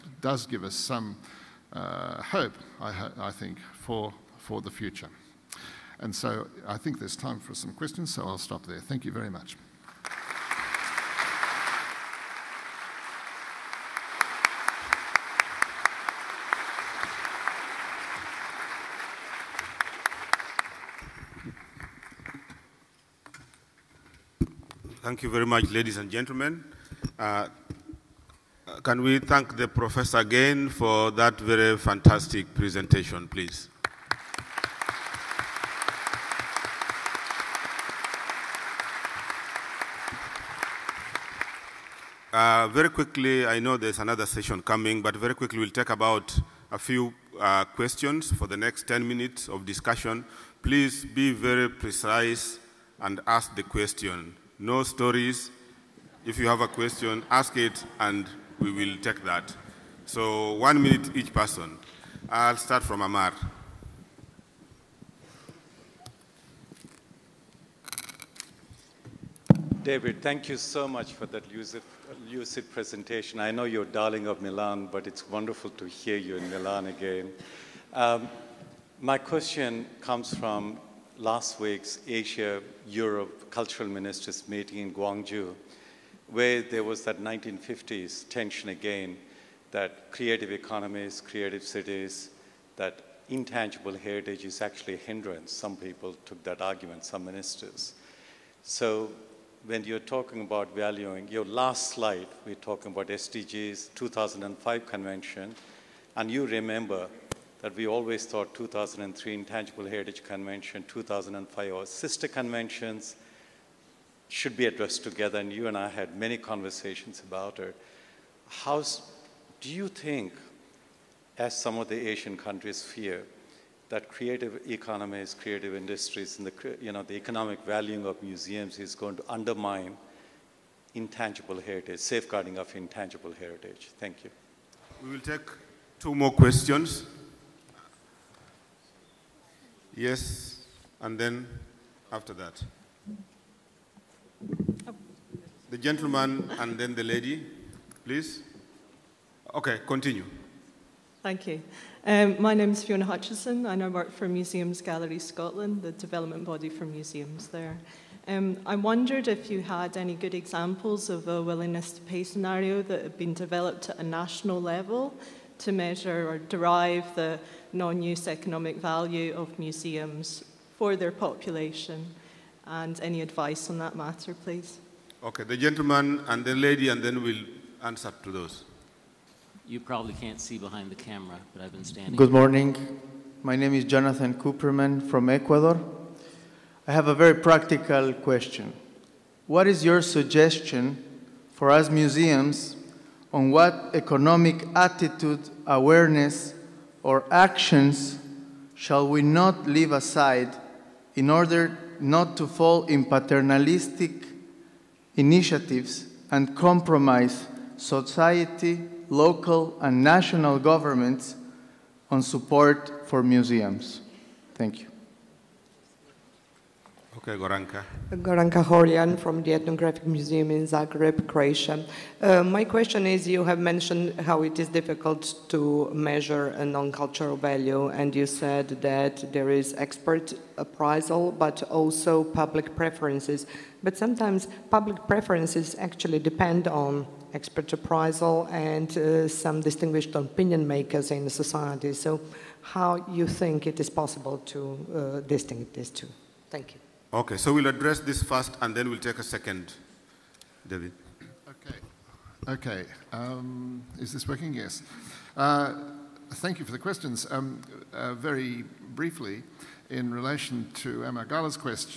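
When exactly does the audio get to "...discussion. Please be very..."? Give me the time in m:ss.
0:49.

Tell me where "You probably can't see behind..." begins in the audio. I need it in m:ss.
2:59.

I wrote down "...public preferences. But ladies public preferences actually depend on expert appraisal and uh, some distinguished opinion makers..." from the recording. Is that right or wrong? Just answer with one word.
wrong.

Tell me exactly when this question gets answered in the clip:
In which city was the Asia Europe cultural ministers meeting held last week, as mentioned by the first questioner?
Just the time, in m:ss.
1:24.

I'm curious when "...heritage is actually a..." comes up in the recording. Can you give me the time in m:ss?
1:33.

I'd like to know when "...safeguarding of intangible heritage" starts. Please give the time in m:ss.
2:12.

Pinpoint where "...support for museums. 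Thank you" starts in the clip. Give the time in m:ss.
3:32.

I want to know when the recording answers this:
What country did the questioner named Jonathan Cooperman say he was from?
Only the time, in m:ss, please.
3:05.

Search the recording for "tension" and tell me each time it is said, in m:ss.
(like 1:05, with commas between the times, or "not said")
1:28.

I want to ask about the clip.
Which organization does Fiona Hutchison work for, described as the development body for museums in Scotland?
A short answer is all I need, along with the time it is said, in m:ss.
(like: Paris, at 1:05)
Museums Gallery Scotland, at 2:34.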